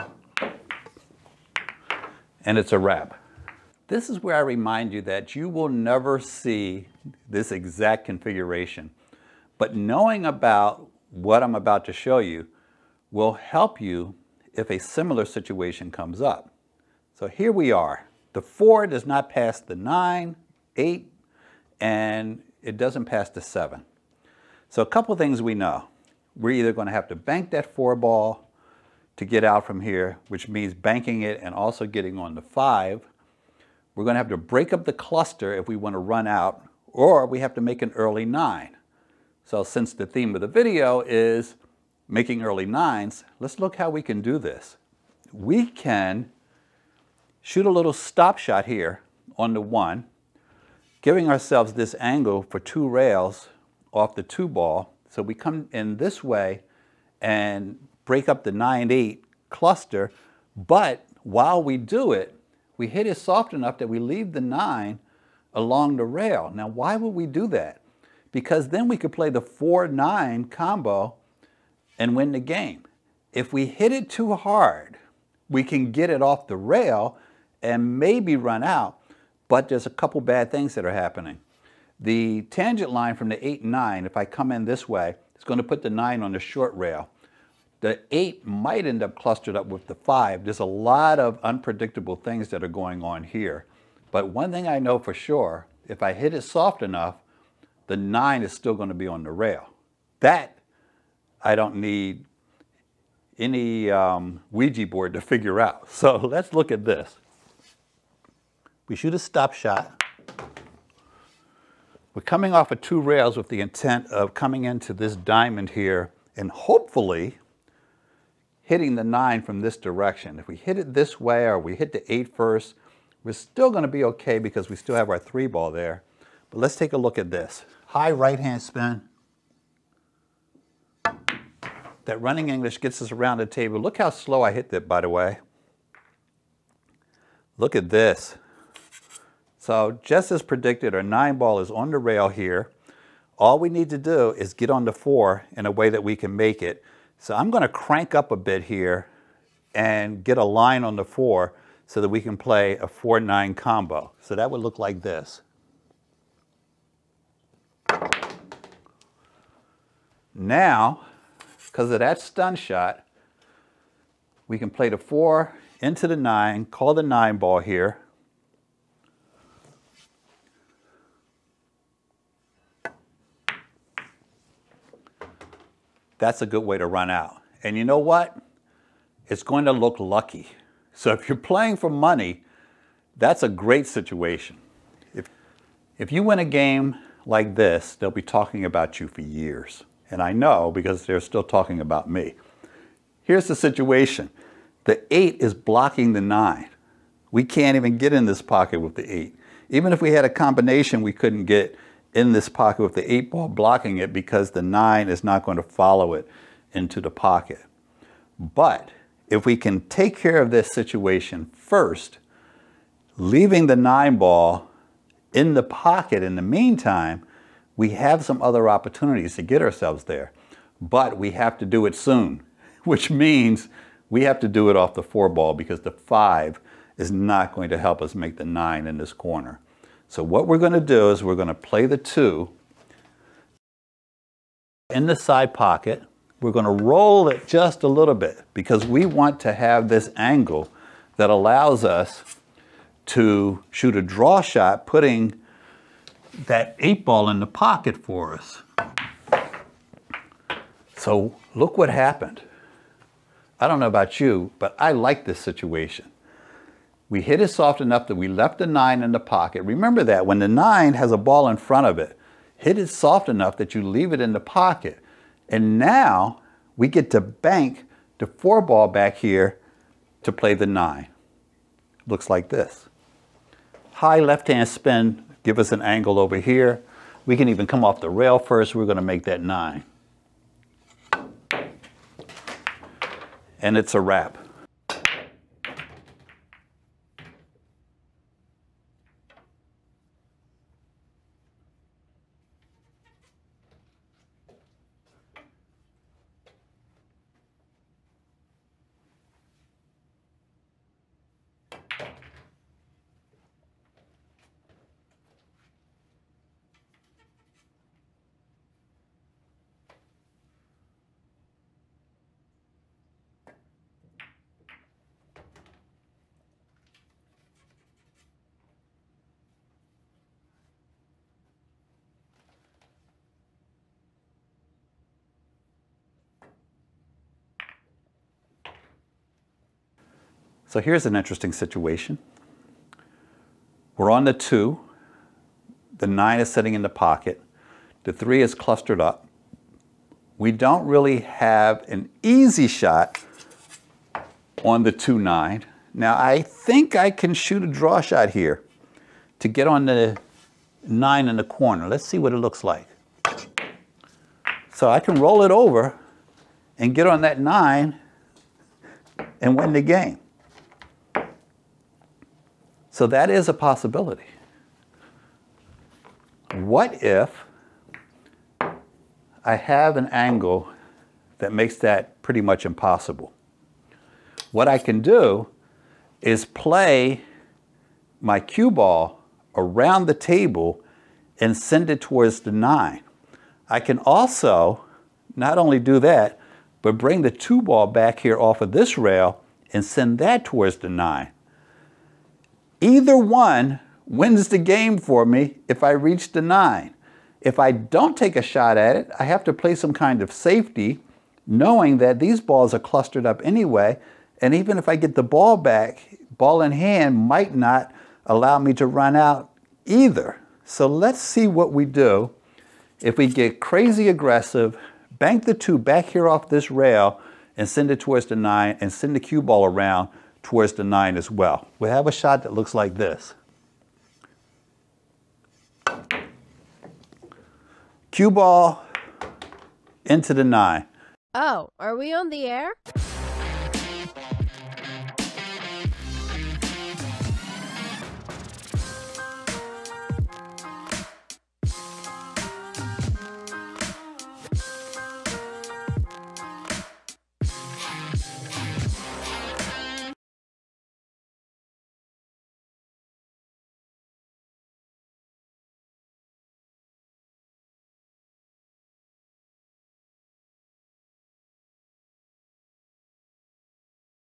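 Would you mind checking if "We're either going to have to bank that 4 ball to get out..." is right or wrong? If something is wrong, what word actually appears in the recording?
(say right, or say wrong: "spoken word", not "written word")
right.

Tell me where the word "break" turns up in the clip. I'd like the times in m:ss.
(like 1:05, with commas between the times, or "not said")
0:34, 0:58.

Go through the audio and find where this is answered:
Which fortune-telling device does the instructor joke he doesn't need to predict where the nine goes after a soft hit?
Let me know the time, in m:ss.
1:44.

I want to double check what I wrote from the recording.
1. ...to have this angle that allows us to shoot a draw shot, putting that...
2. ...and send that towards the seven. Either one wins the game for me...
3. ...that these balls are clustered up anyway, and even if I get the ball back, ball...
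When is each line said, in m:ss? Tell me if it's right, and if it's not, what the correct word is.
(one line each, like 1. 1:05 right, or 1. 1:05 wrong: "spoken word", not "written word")
1. 3:59 right
2. 6:29 wrong: "nine", not "seven"
3. 6:41 right.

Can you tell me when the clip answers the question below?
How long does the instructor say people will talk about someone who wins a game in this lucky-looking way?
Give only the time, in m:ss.
3:09.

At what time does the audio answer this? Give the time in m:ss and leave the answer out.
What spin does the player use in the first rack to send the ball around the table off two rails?
2:07.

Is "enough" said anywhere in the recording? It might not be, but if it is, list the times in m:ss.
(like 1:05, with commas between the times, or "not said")
1:03, 1:36, 4:17, 4:23.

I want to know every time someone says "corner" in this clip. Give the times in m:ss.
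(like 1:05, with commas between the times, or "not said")
3:49, 5:51.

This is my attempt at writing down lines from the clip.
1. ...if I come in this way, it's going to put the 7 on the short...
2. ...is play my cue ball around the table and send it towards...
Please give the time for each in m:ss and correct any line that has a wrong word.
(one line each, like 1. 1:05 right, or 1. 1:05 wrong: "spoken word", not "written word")
1. 1:24 wrong: "9", not "7"
2. 6:16 right.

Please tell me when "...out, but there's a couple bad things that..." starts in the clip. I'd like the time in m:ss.
1:18.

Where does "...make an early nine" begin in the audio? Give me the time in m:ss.
0:37.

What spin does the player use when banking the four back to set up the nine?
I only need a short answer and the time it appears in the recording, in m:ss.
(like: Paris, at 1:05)
High left hand spin, at 4:33.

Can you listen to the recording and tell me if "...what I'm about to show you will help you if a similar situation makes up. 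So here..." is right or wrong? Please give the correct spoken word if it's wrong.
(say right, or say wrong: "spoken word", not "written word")
wrong: "comes", not "makes".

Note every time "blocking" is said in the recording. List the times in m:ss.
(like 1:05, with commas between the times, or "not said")
3:15, 3:23.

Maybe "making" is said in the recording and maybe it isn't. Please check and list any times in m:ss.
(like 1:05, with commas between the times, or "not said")
0:42.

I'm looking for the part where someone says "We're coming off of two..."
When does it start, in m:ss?
1:52.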